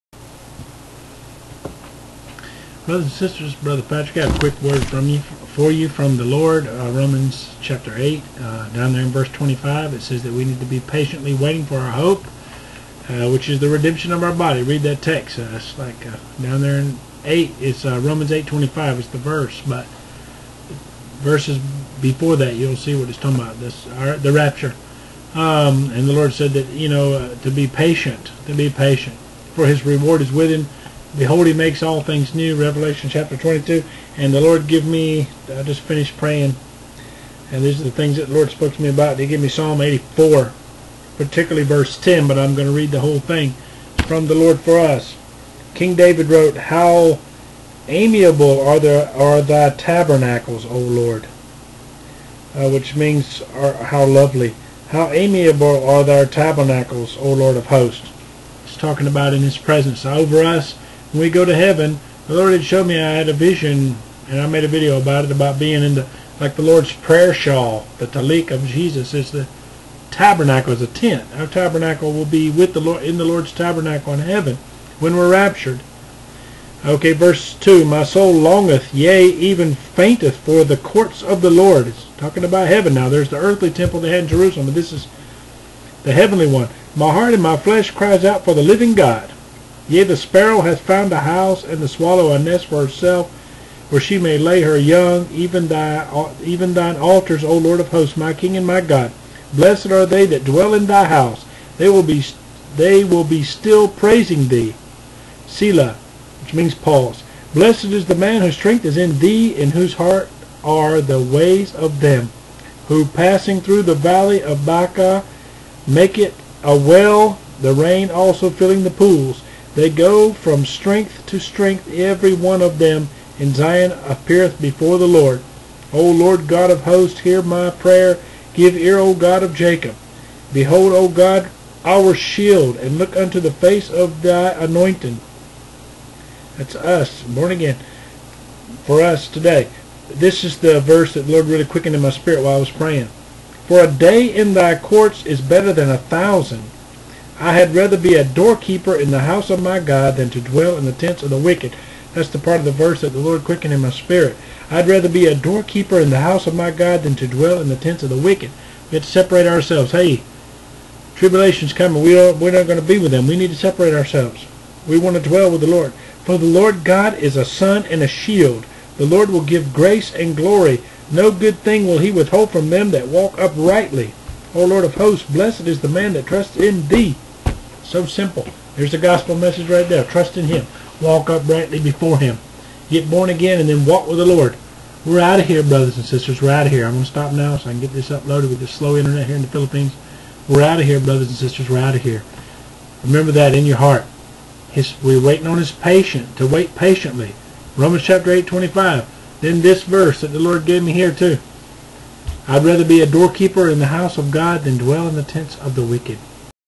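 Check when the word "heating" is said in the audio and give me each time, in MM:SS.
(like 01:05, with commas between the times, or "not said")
not said.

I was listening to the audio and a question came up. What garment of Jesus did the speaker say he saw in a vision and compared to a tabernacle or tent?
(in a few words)
tallit.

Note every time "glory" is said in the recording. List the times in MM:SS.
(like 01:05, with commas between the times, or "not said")
02:50.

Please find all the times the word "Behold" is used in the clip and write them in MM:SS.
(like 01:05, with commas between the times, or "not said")
00:31, 02:10.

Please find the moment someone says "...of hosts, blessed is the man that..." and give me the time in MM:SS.
02:54.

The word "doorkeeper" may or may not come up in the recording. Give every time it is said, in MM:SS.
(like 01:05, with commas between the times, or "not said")
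02:28, 02:35, 03:23.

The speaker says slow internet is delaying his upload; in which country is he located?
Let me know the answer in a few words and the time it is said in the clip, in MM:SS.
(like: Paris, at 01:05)
Philippines, at 03:09.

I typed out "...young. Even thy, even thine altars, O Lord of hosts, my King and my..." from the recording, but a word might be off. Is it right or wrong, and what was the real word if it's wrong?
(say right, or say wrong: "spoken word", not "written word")
right.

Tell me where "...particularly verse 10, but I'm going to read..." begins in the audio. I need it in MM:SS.
00:41.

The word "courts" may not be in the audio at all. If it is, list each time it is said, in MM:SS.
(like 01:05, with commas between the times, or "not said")
01:20, 02:24.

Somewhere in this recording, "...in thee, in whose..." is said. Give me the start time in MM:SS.
01:48.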